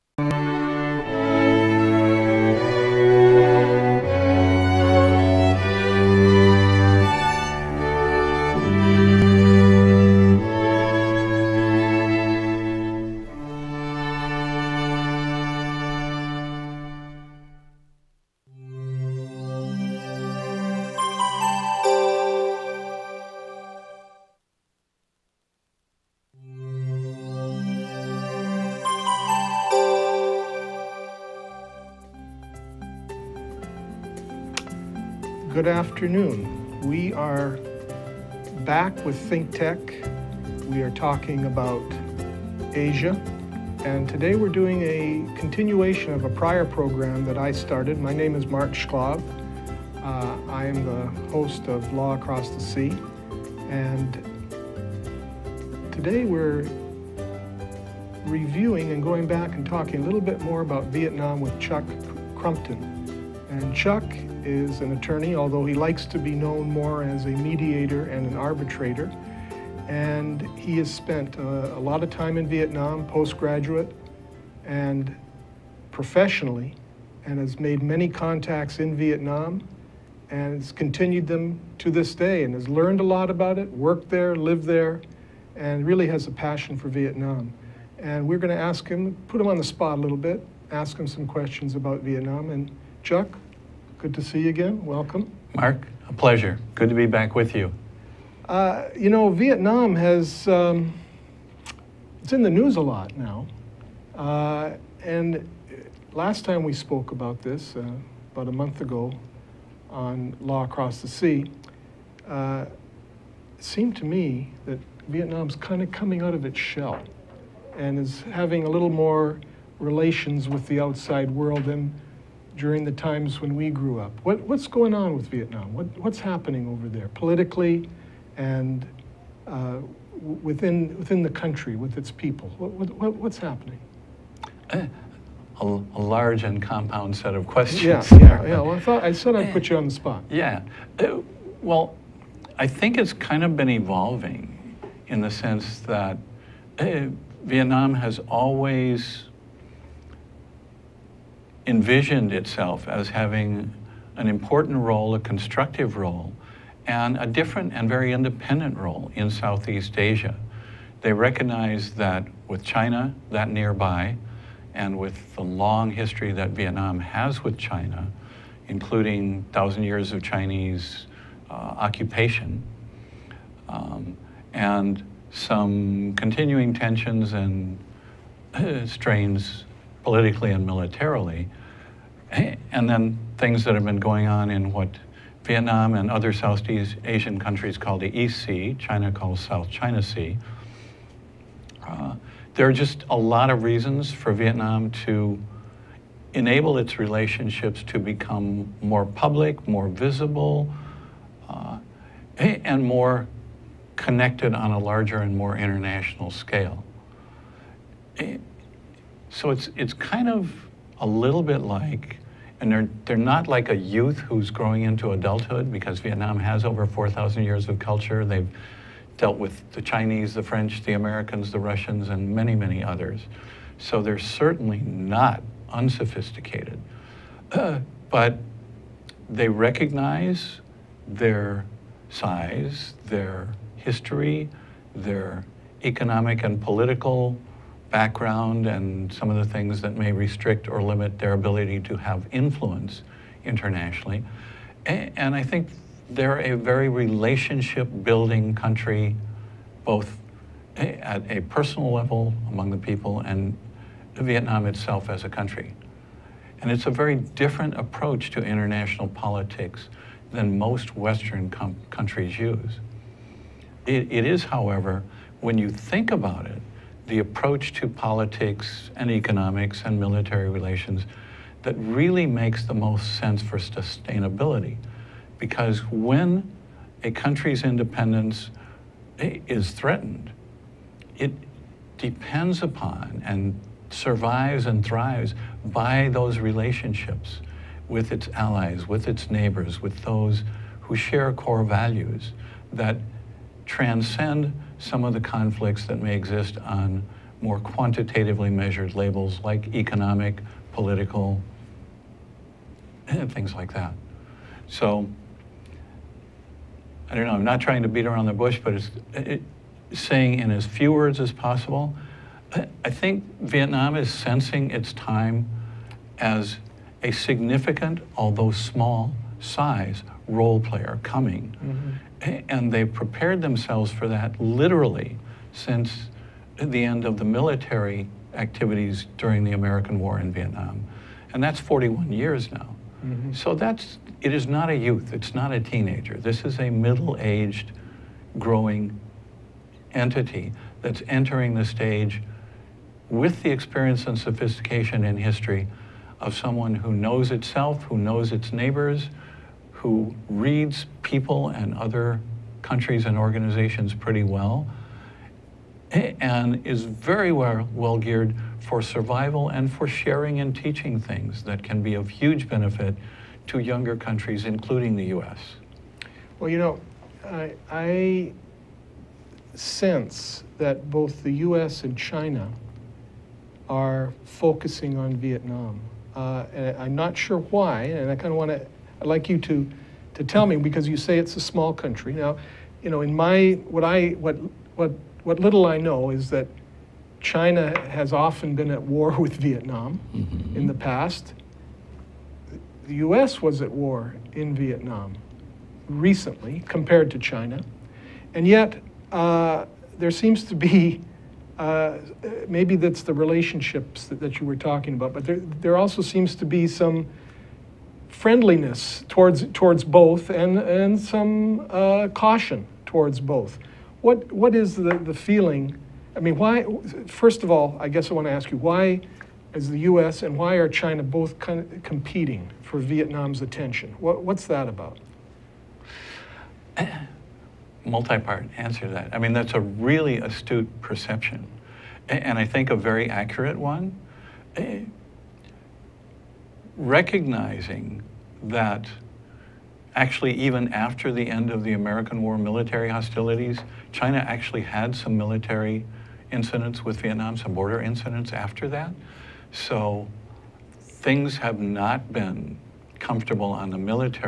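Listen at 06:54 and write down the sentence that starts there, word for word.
What, what is the, the feeling?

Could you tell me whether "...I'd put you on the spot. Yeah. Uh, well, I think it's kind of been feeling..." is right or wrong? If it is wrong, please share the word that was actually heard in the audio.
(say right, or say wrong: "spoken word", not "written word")
wrong: "evolving", not "feeling".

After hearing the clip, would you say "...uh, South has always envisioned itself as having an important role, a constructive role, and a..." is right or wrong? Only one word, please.
wrong.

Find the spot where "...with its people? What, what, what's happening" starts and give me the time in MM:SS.
02:11.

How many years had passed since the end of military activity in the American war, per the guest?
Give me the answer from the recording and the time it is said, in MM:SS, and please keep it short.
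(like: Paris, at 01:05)
41 years, at 05:31.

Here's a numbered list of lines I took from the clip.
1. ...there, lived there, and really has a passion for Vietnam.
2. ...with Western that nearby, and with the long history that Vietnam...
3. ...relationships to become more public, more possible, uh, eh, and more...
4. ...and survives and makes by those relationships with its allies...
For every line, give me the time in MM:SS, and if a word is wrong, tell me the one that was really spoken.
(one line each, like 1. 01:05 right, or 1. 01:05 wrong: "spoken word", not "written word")
1. 01:24 right
2. 02:42 wrong: "China", not "Western"
3. 03:16 wrong: "visible", not "possible"
4. 04:43 wrong: "thrives", not "makes".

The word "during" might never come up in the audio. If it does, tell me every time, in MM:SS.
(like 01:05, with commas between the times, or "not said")
02:02, 05:29.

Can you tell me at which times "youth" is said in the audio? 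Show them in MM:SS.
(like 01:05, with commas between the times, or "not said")
03:33, 05:34.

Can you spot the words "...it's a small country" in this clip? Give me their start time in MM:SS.
06:21.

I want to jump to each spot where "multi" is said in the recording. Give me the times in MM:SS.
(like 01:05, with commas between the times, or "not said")
07:07.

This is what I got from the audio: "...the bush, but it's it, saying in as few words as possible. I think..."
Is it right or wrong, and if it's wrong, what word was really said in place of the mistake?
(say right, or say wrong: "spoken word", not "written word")
right.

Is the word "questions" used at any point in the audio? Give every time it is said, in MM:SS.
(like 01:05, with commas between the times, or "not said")
01:31, 02:17.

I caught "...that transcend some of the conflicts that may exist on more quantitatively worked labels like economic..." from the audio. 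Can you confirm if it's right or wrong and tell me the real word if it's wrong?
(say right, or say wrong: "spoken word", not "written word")
wrong: "measured", not "worked".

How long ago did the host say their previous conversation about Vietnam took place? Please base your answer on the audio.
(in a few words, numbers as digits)
About a month.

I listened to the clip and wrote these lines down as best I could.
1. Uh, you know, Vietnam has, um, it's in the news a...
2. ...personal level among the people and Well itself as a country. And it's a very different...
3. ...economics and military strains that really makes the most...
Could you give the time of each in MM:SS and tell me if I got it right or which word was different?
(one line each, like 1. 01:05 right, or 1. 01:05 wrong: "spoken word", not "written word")
1. 01:38 right
2. 04:11 wrong: "Vietnam", not "Well"
3. 04:29 wrong: "relations", not "strains".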